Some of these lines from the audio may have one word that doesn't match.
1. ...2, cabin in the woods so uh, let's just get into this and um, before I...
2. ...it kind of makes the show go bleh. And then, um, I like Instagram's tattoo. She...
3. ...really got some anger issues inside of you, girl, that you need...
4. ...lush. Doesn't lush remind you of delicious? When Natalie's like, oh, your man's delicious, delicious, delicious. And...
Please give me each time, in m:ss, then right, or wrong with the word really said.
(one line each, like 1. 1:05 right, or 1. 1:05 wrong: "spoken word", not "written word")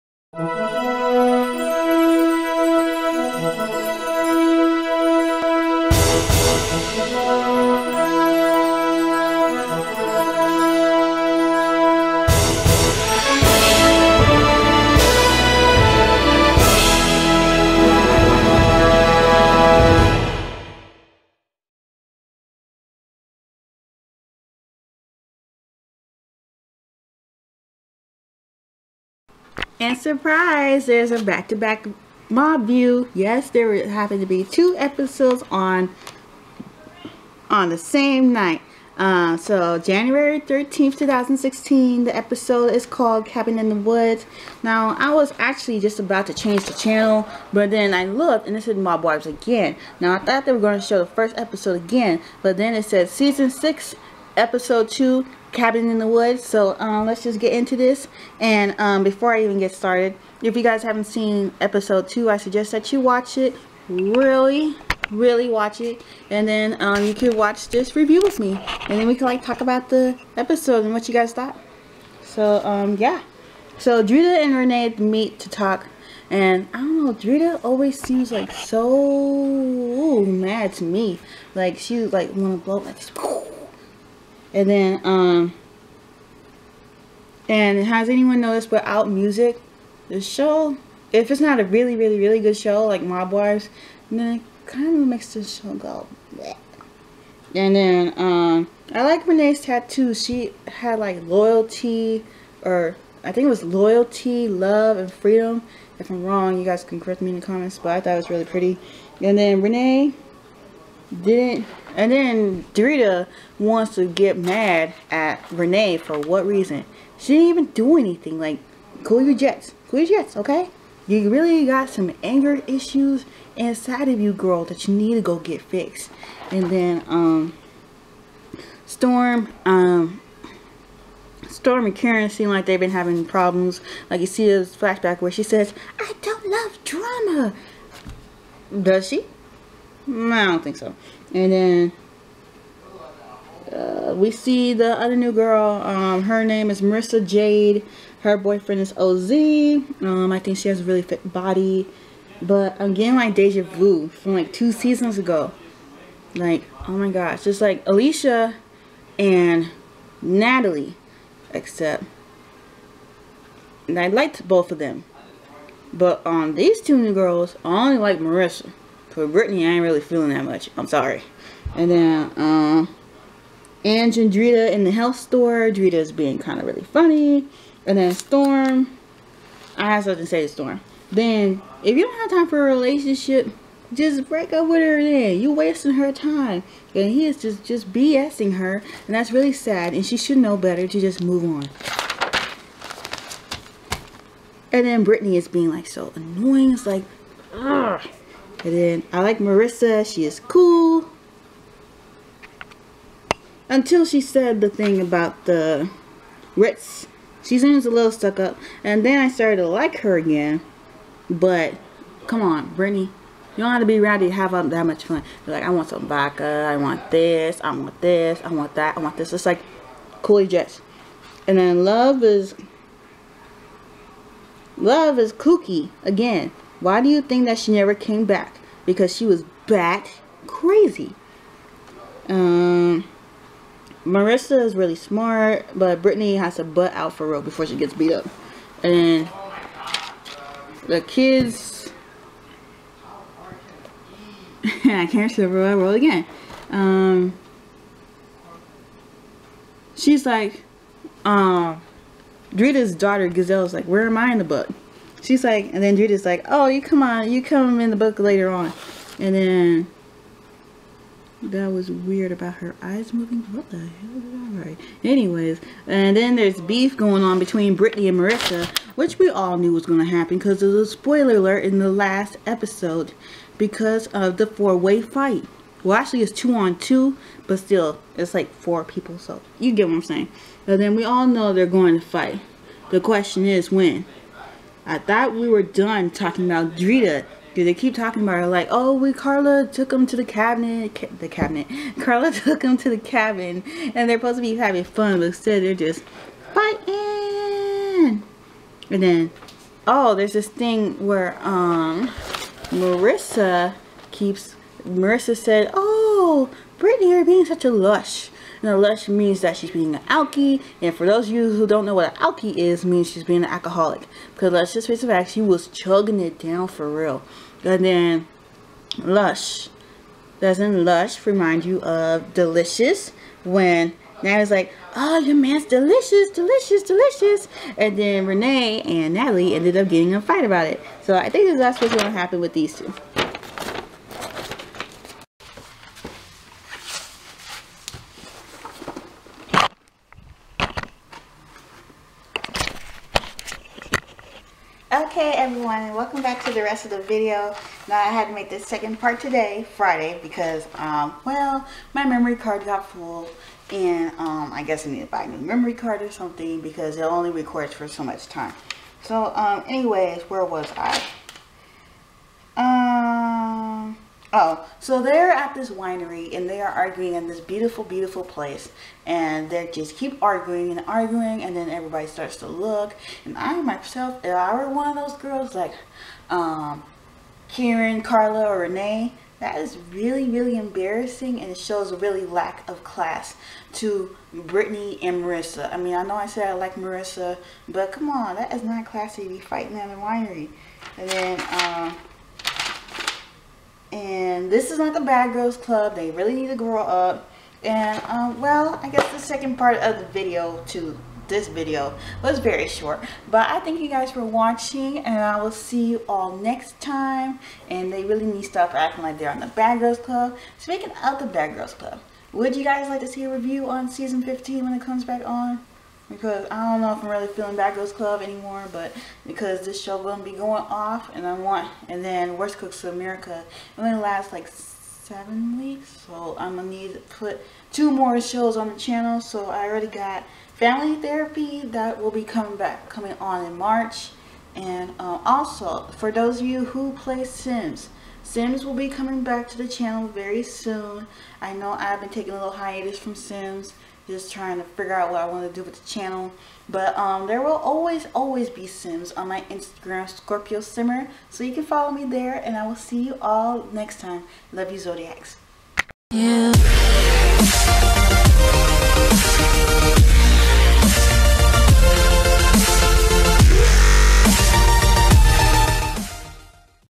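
1. 0:54 right
2. 1:34 wrong: "Renee", not "Instagram"
3. 2:01 right
4. 5:18 right.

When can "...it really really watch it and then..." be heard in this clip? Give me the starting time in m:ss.
1:03.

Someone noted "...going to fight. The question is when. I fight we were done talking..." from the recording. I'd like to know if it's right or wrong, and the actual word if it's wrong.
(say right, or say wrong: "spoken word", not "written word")
wrong: "thought", not "fight".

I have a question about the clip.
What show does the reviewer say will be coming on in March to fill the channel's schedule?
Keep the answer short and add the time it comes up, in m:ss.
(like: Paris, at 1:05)
Family Therapy, at 7:10.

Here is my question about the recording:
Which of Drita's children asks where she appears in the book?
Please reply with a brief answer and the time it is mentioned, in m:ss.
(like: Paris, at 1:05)
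Gazelle, at 4:13.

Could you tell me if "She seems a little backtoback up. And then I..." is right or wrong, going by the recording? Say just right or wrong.
wrong.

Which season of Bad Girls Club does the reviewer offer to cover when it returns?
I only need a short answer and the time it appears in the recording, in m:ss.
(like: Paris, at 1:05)
15, at 6:53.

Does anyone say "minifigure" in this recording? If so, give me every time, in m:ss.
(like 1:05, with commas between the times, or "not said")
not said.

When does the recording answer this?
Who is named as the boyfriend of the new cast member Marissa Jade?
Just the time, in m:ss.
2:28.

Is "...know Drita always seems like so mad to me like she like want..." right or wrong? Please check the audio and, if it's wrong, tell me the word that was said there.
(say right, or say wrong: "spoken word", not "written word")
right.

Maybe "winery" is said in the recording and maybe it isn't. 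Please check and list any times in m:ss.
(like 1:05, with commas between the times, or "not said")
6:05, 6:29.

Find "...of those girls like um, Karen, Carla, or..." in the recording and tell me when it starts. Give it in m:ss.
6:14.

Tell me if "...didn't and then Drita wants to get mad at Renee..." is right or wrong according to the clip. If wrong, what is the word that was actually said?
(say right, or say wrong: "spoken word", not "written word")
right.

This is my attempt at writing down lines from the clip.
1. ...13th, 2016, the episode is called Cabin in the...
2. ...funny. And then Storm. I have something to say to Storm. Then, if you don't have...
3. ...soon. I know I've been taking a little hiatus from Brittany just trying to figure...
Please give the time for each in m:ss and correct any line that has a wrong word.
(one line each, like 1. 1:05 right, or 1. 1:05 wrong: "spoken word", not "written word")
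1. 0:40 right
2. 2:56 right
3. 7:20 wrong: "Sims", not "Brittany".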